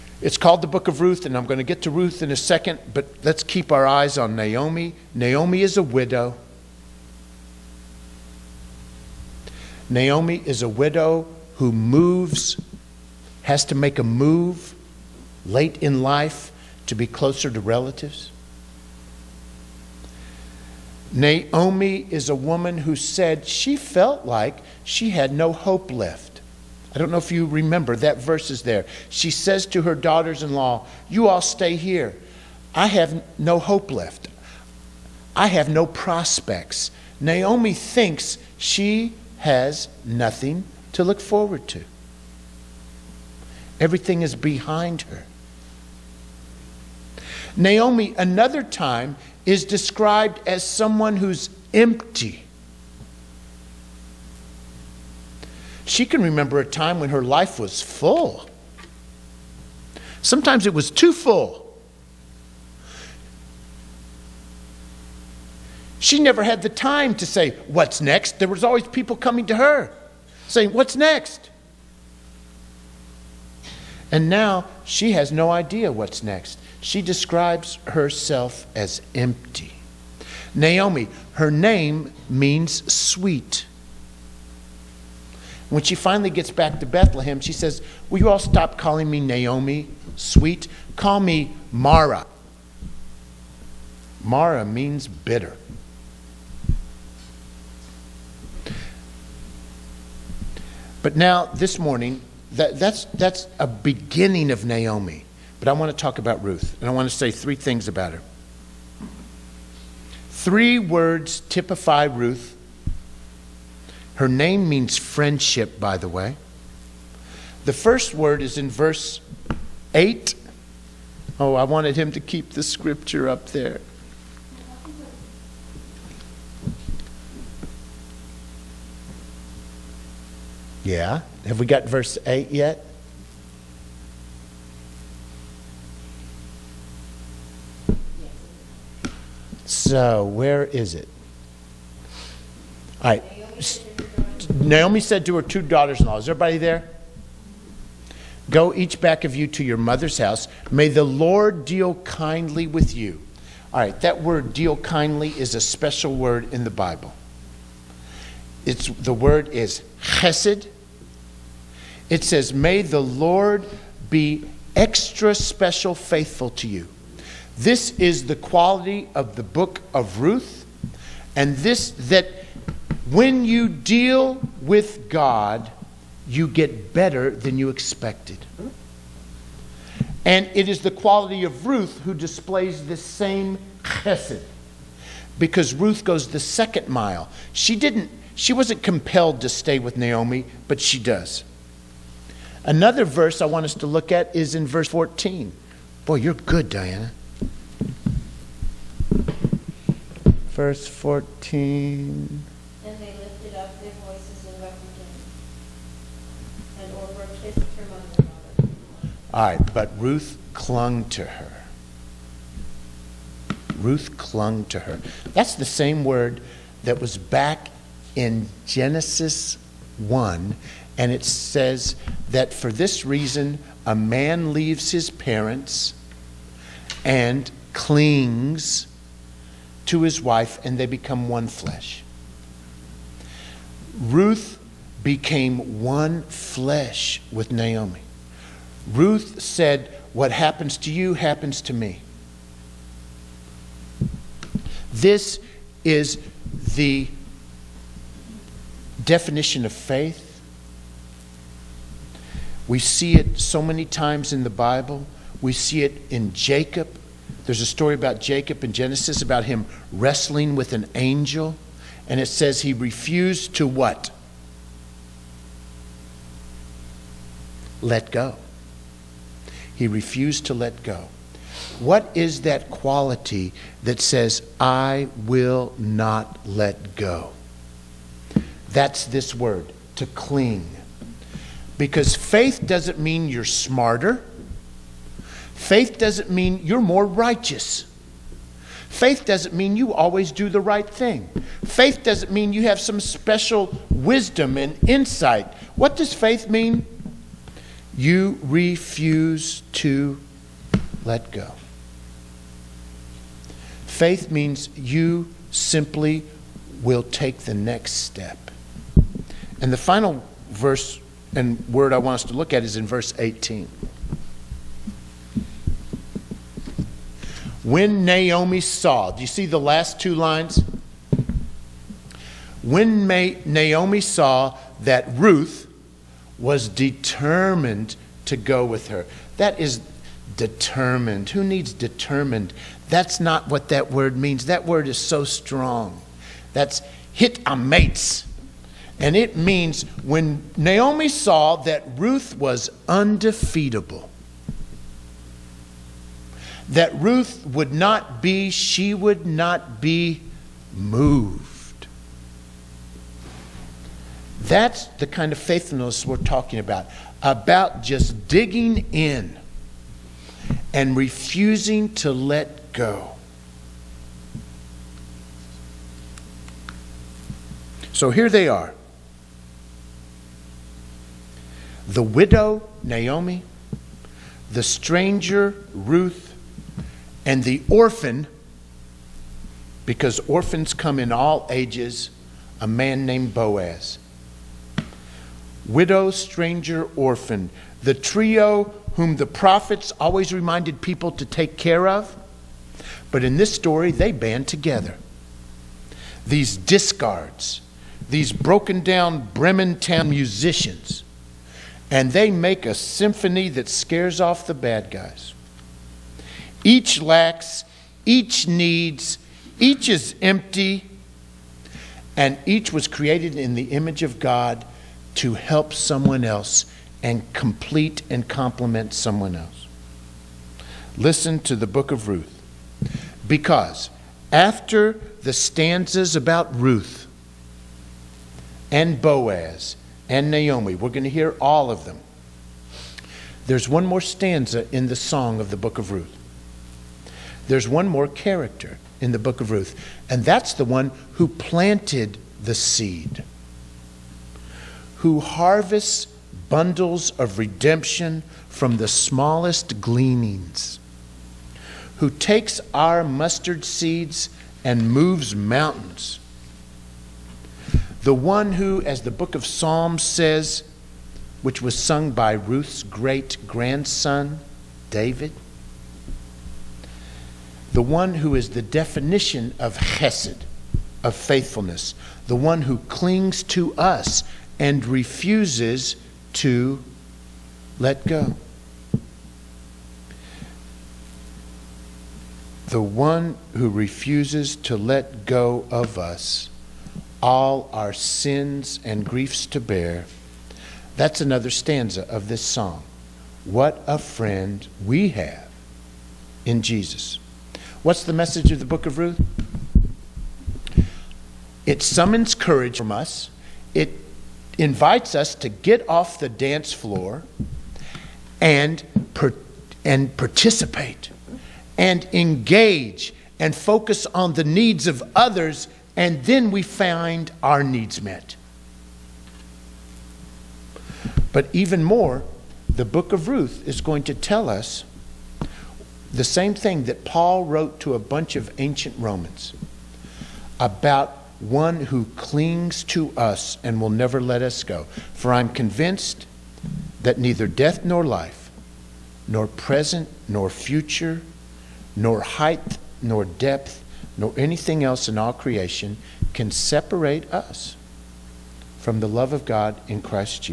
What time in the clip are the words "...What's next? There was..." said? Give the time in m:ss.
1:07.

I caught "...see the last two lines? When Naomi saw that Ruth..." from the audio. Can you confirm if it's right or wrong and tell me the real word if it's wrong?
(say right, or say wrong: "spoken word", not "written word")
right.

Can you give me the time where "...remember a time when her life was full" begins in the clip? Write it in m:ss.
0:56.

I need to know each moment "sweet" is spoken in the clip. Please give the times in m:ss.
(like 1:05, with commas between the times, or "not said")
1:22, 1:30.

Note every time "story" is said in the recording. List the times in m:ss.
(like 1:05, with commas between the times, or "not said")
4:17, 6:33.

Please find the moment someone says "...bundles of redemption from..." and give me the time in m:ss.
7:26.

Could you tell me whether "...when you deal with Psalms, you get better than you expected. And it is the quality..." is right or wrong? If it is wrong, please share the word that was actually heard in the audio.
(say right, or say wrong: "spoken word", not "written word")
wrong: "God", not "Psalms".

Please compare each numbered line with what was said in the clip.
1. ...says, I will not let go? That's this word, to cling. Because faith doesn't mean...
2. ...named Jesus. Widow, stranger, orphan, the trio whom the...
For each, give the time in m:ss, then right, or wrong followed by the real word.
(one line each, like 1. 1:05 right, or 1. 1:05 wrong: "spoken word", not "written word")
1. 4:34 right
2. 6:23 wrong: "Boaz", not "Jesus".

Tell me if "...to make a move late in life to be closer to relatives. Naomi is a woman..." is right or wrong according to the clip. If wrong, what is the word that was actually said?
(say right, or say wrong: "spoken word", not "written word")
right.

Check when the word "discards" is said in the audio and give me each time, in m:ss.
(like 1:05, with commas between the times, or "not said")
6:36.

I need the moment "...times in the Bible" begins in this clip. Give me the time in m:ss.
4:13.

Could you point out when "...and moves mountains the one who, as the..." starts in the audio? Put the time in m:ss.
7:34.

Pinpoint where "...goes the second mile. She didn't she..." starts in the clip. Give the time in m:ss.
3:06.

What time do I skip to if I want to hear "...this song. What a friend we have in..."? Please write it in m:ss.
8:12.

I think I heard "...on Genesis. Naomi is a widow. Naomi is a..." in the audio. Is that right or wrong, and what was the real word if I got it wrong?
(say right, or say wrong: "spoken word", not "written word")
wrong: "Naomi", not "Genesis".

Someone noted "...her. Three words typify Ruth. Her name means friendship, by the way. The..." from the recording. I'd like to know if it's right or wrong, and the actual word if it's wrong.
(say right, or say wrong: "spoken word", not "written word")
right.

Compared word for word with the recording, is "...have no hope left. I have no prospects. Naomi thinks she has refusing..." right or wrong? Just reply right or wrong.
wrong.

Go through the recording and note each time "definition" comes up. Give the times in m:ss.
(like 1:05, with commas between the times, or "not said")
4:09, 7:48.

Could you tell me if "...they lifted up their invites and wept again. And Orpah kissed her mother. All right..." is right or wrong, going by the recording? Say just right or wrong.
wrong.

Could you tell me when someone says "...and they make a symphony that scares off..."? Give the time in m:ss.
6:41.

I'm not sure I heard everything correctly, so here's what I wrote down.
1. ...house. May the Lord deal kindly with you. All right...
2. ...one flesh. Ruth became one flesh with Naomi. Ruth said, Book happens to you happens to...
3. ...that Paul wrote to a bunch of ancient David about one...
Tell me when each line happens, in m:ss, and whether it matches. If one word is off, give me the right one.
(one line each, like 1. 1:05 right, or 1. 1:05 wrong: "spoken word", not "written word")
1. 2:30 right
2. 3:51 wrong: "What", not "Book"
3. 8:46 wrong: "Romans", not "David".